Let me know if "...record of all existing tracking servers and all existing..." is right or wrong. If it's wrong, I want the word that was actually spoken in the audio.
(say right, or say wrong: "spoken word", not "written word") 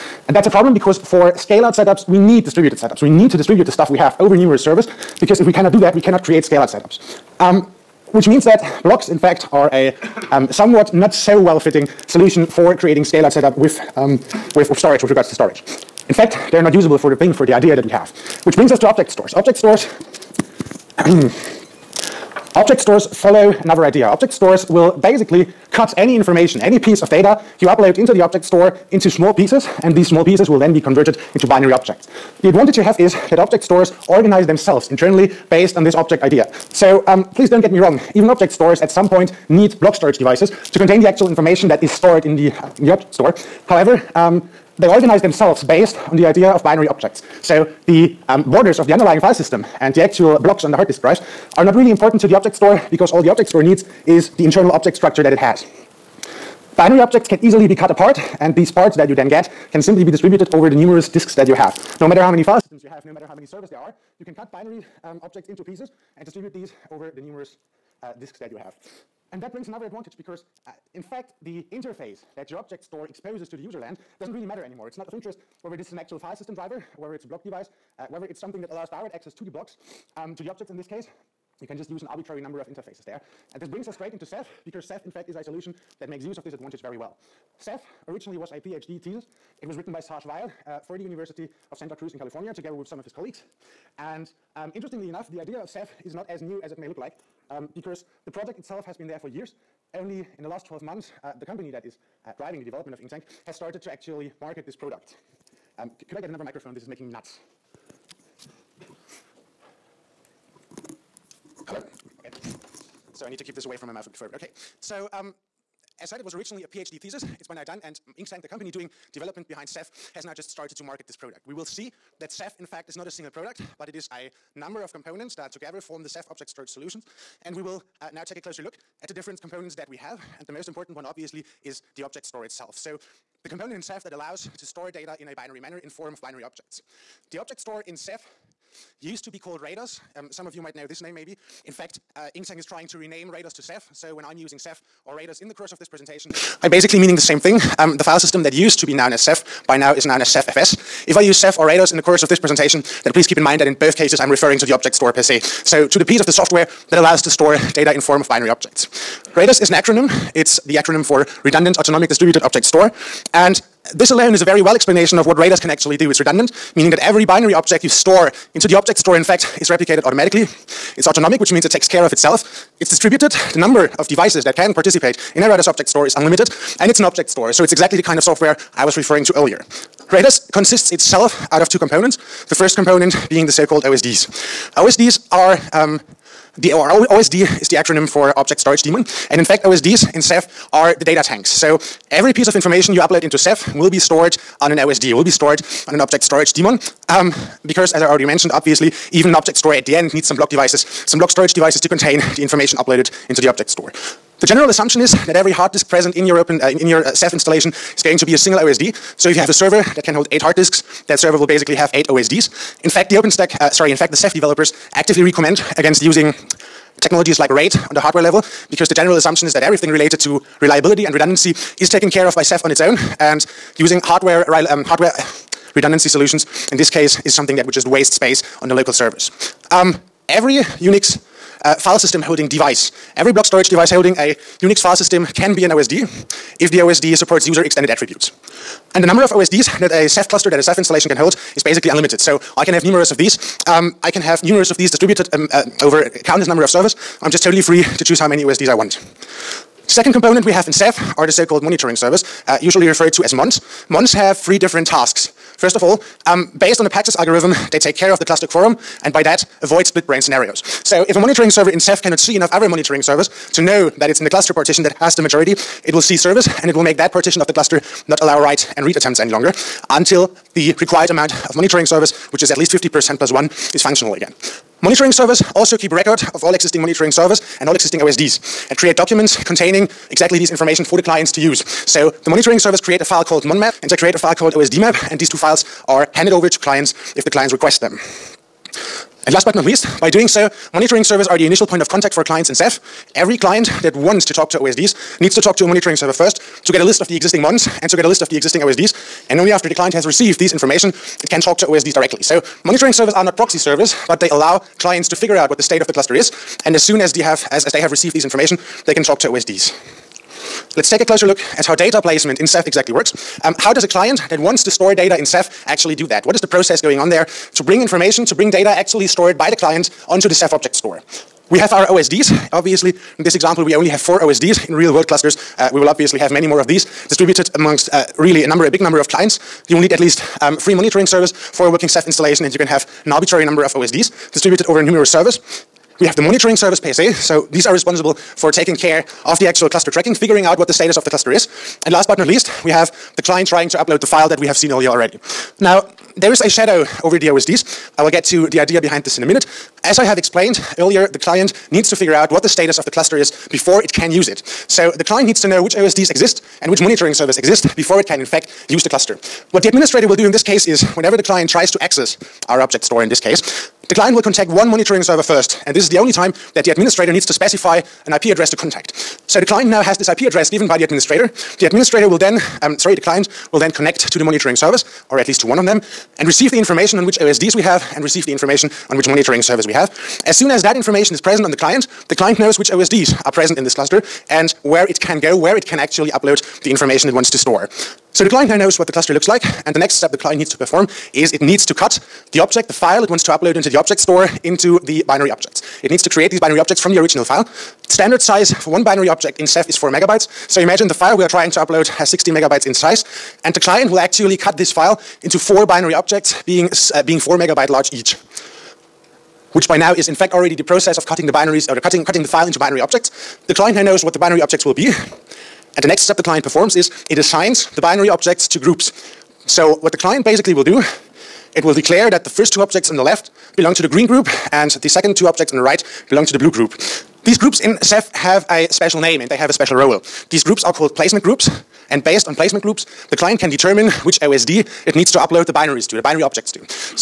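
wrong: "monitoring", not "tracking".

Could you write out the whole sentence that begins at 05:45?
Now, there is a shadow over the OSDs.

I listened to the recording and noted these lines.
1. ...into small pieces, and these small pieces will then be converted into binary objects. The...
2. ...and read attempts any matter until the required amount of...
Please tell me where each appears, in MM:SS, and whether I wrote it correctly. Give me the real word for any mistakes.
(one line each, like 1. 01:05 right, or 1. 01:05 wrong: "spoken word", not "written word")
1. 00:28 right
2. 04:28 wrong: "longer", not "matter".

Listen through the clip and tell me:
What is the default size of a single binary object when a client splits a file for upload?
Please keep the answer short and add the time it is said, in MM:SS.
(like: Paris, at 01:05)
4 megabytes, at 06:39.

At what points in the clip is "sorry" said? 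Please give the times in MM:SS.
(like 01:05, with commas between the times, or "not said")
03:33, 06:12.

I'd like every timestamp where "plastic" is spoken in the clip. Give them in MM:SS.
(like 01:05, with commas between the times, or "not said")
not said.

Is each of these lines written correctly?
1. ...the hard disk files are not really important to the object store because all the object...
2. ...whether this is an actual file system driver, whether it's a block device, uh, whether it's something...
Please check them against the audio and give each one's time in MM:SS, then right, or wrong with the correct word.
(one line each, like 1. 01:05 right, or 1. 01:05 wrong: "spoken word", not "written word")
1. 00:50 wrong: "drives", not "files"
2. 01:15 right.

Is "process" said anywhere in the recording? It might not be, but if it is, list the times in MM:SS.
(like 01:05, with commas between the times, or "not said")
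05:16, 06:50.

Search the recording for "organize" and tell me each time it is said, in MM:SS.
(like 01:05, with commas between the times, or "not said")
00:34, 00:44.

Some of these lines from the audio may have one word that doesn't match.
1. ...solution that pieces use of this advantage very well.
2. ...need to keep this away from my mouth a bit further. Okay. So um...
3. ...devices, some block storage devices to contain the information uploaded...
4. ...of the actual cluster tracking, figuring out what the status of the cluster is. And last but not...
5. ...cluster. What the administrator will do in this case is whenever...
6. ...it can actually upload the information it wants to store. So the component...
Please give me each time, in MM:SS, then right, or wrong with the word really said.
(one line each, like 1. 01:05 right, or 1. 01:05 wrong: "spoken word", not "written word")
1. 01:25 wrong: "makes", not "pieces"
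2. 01:53 right
3. 03:20 right
4. 05:39 right
5. 05:58 right
6. 06:25 wrong: "client", not "component".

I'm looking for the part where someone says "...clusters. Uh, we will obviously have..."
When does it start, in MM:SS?
05:25.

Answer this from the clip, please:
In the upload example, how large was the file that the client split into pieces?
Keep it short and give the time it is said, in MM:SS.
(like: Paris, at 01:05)
16 megabytes, at 06:42.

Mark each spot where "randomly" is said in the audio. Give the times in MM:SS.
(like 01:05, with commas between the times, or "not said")
not said.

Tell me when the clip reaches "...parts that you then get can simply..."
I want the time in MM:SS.
00:58.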